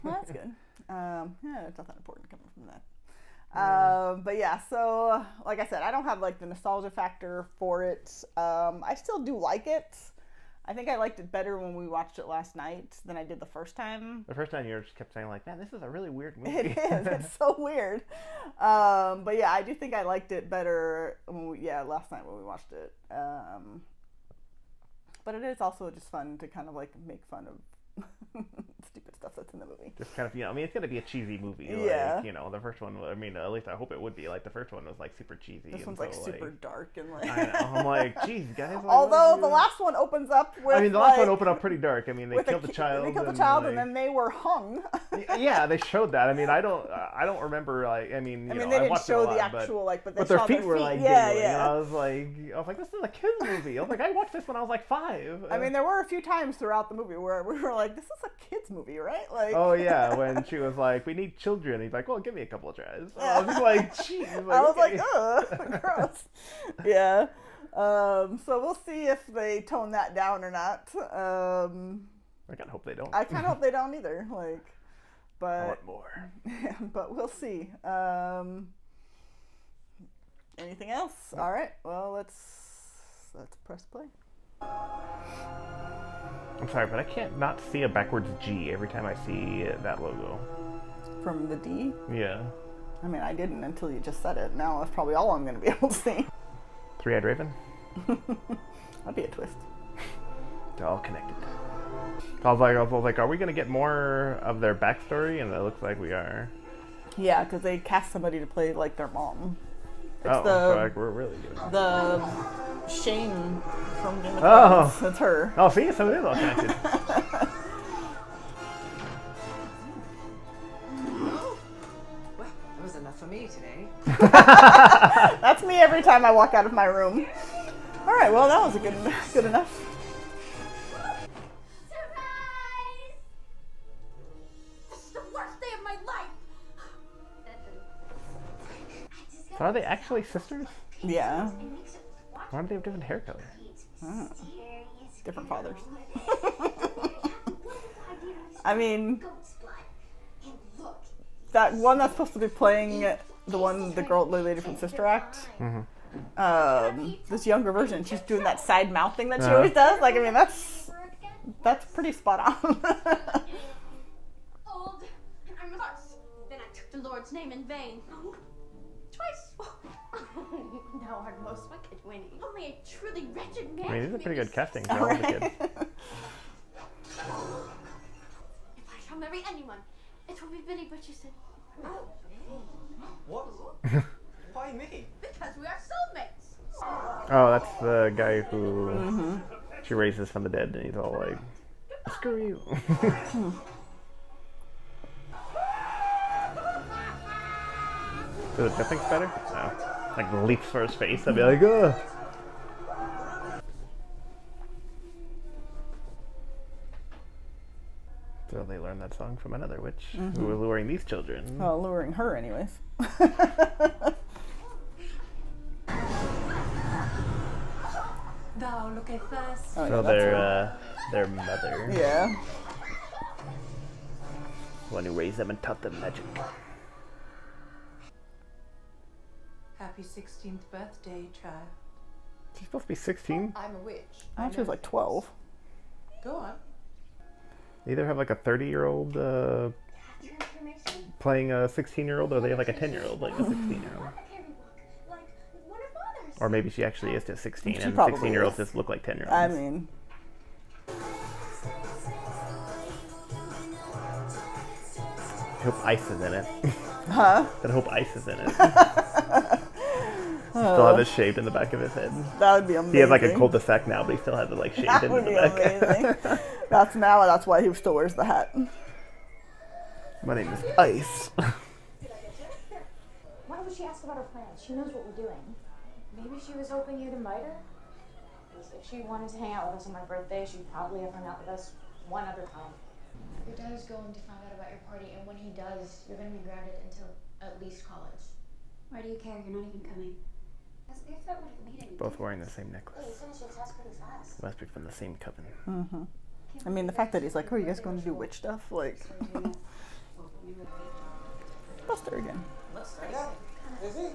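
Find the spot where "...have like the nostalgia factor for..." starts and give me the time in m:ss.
0:06.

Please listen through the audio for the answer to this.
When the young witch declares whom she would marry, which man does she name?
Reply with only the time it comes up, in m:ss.
3:00.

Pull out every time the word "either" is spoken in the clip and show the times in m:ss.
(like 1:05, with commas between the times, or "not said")
1:13, 3:57.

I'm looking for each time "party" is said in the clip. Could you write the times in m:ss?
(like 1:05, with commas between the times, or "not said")
4:44.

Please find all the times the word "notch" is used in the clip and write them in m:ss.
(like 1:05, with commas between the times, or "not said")
not said.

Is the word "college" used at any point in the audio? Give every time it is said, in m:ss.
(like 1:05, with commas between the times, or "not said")
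4:47.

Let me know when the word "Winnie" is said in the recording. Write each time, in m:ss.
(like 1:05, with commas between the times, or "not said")
2:52.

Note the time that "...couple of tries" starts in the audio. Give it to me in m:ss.
1:02.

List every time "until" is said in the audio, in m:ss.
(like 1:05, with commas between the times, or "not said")
1:33, 4:46.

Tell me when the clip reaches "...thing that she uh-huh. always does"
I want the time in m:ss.
2:39.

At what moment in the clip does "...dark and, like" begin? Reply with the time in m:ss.
0:36.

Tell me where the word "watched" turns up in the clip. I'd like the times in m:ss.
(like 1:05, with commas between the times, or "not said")
0:11, 0:22, 0:54.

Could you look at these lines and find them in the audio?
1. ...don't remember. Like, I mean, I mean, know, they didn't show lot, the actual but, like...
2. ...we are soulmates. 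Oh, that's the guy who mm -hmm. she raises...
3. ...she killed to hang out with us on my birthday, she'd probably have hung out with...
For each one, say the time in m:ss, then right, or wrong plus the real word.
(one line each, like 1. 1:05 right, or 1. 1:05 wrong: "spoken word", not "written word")
1. 0:47 right
2. 3:05 right
3. 4:38 wrong: "wanted", not "killed".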